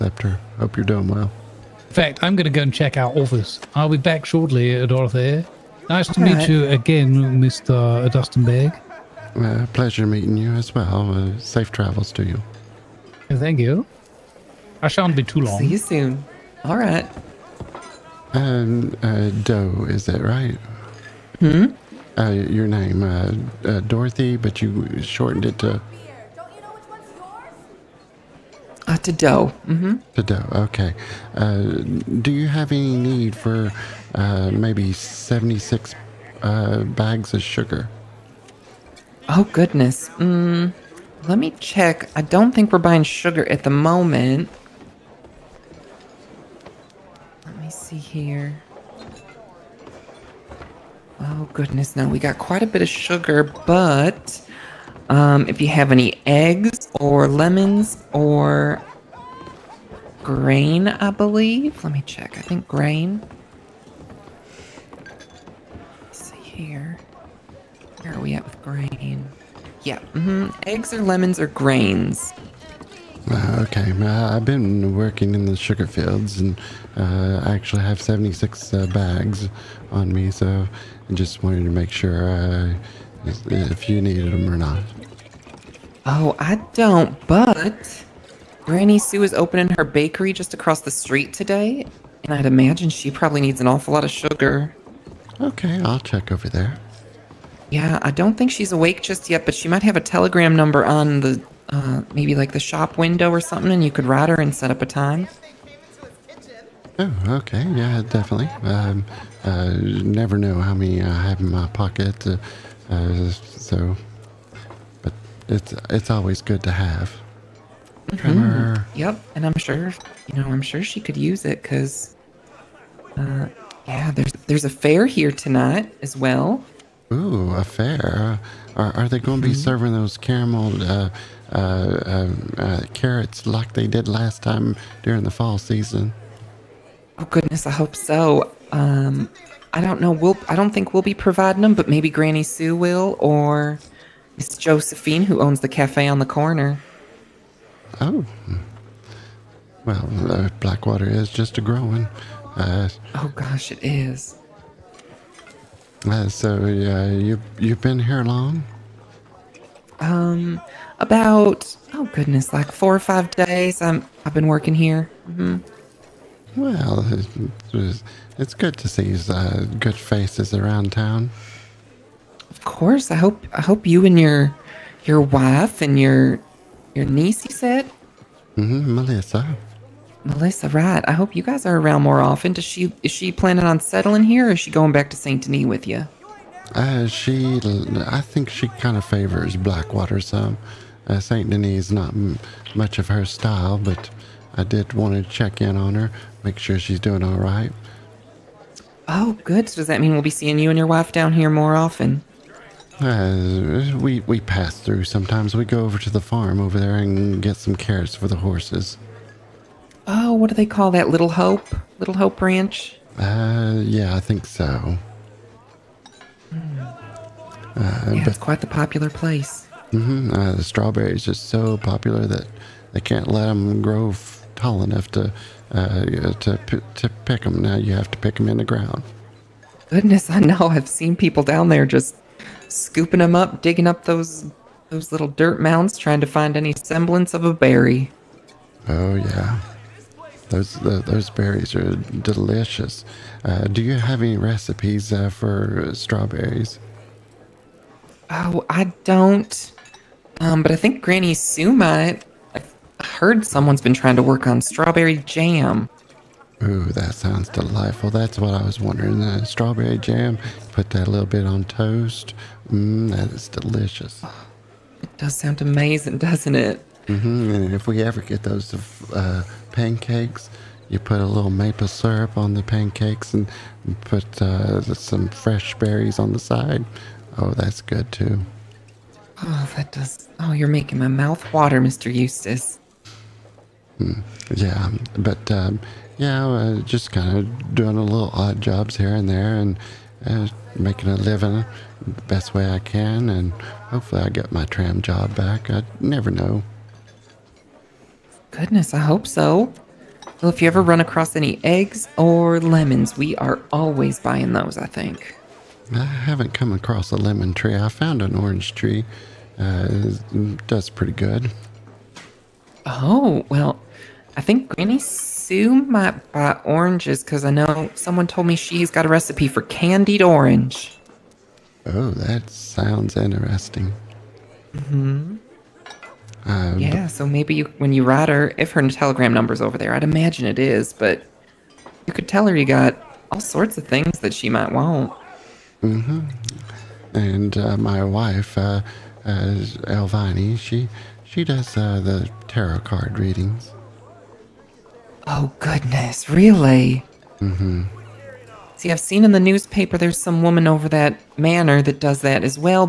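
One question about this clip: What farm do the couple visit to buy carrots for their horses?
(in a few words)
Little Hope Ranch.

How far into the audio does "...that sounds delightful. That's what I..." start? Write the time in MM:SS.
04:16.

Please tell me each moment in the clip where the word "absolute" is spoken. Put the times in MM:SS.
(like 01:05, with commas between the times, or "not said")
not said.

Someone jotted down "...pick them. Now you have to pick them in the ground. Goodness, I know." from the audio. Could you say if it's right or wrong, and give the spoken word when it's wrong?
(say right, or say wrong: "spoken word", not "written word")
right.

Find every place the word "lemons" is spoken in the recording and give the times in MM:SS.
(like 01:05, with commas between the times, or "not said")
00:57, 01:11, 05:02, 05:07.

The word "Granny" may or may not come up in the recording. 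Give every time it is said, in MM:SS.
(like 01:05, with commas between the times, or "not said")
01:28, 02:22, 04:11, 05:14.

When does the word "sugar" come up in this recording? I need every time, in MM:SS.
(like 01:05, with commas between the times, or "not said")
00:37, 00:43, 00:52, 01:15, 01:34.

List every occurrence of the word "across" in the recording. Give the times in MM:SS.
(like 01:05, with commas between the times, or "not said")
01:30, 05:01, 05:06.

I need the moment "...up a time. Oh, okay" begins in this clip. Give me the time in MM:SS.
01:44.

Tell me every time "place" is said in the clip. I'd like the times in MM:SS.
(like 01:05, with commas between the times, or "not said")
03:39.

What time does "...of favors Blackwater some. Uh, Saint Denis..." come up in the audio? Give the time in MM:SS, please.
03:08.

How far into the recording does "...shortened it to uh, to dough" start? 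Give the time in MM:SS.
00:25.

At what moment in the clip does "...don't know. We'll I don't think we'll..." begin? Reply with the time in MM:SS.
02:19.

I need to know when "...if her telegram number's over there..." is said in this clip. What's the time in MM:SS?
05:28.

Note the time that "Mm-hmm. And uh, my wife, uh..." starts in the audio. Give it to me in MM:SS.
05:35.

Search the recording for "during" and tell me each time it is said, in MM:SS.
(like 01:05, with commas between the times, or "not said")
02:15.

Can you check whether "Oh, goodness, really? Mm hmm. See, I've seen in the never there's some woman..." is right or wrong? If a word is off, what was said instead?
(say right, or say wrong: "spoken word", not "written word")
wrong: "newspaper", not "never".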